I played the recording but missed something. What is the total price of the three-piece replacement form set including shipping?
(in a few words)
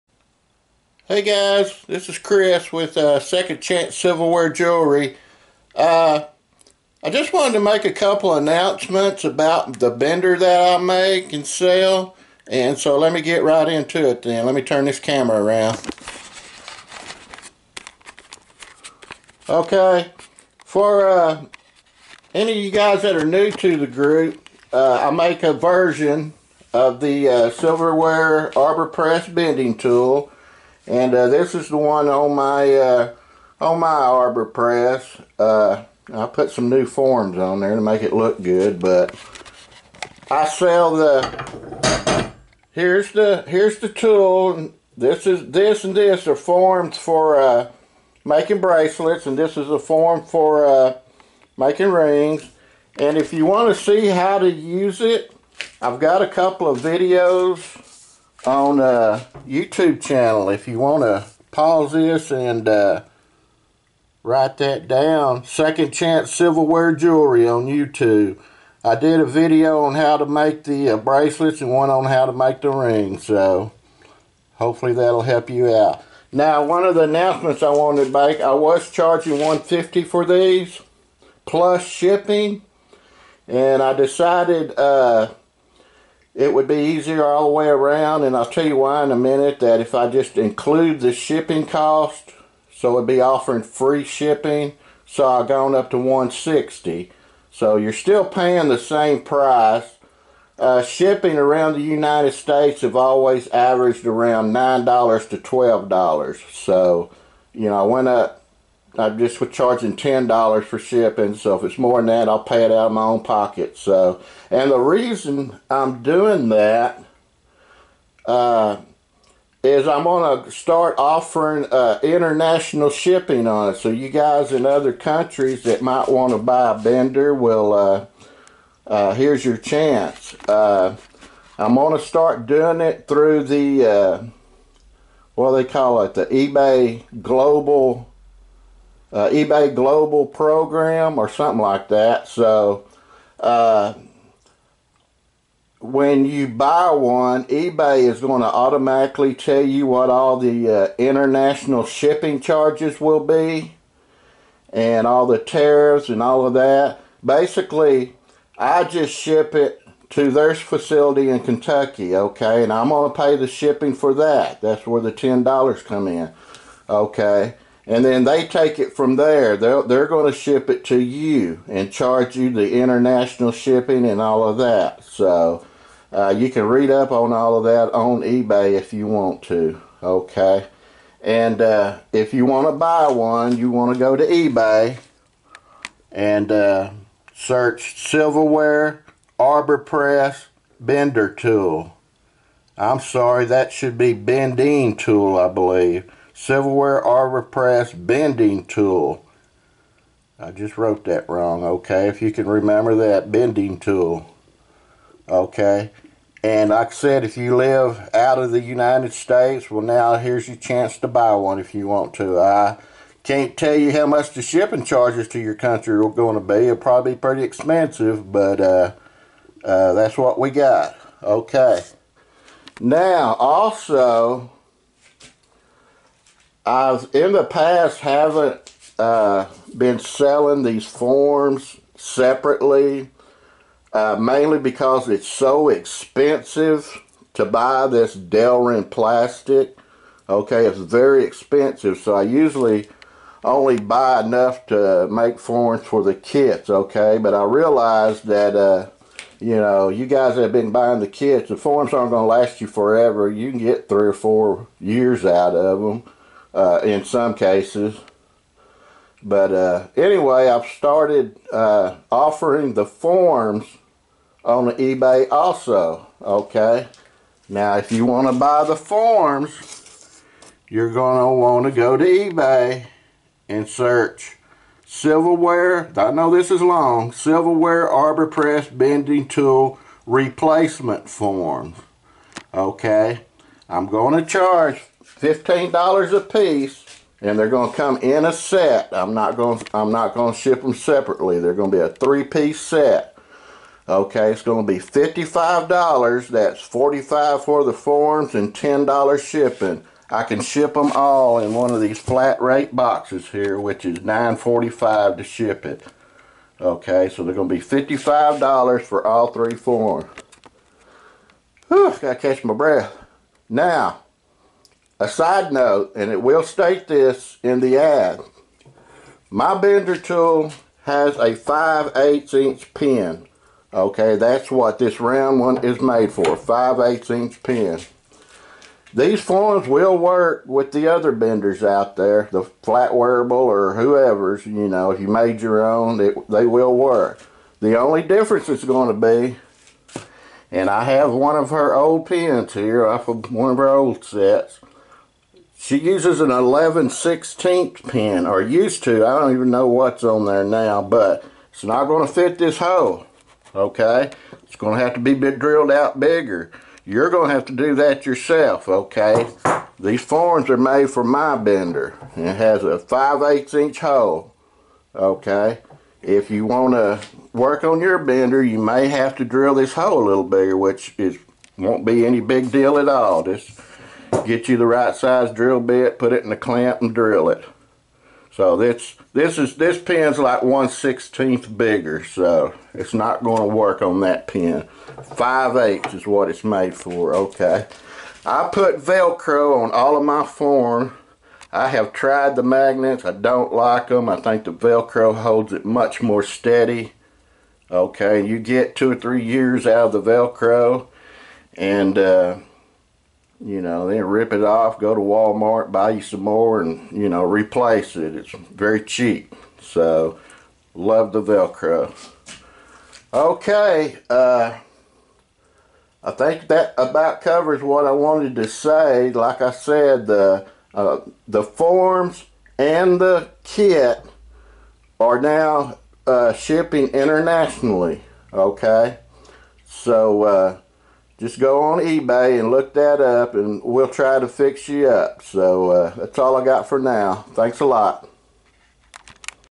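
$55.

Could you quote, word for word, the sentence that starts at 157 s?
Basically, I just ship it to their facility in Kentucky, okay, and I'm going to pay the shipping for that.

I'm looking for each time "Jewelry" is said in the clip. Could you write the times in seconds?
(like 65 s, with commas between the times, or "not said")
4 s, 66 s.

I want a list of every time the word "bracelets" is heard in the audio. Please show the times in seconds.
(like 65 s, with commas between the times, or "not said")
48 s, 70 s.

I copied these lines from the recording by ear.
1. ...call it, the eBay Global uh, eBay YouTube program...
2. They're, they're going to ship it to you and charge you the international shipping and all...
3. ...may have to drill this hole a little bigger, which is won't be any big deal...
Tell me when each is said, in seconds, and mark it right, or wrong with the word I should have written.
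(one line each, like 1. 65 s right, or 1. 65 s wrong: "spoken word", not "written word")
1. 135 s wrong: "Global", not "YouTube"
2. 169 s right
3. 368 s right.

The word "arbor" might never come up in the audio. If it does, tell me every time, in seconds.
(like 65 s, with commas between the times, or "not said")
28 s, 33 s, 189 s, 197 s, 277 s.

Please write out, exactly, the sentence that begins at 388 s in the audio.
I put Velcro on all of my form.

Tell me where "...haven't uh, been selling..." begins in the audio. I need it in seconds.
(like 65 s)
228 s.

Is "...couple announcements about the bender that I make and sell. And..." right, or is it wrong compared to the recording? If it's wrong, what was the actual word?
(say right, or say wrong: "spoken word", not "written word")
right.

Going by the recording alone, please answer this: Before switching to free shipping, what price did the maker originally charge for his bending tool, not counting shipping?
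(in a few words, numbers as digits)
$150.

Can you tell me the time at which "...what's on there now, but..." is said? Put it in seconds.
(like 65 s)
349 s.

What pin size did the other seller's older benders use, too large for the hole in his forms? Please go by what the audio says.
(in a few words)
11/16 inch.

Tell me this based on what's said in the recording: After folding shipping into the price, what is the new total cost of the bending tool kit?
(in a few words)
$160.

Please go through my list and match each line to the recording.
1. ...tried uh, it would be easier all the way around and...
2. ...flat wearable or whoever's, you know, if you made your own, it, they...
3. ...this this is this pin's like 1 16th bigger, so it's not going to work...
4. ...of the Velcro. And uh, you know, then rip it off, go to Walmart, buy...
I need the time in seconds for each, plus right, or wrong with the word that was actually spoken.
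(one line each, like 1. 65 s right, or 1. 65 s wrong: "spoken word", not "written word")
1. 83 s wrong: "decided", not "tried"
2. 332 s right
3. 378 s right
4. 399 s right.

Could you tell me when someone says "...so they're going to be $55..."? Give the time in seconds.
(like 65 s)
307 s.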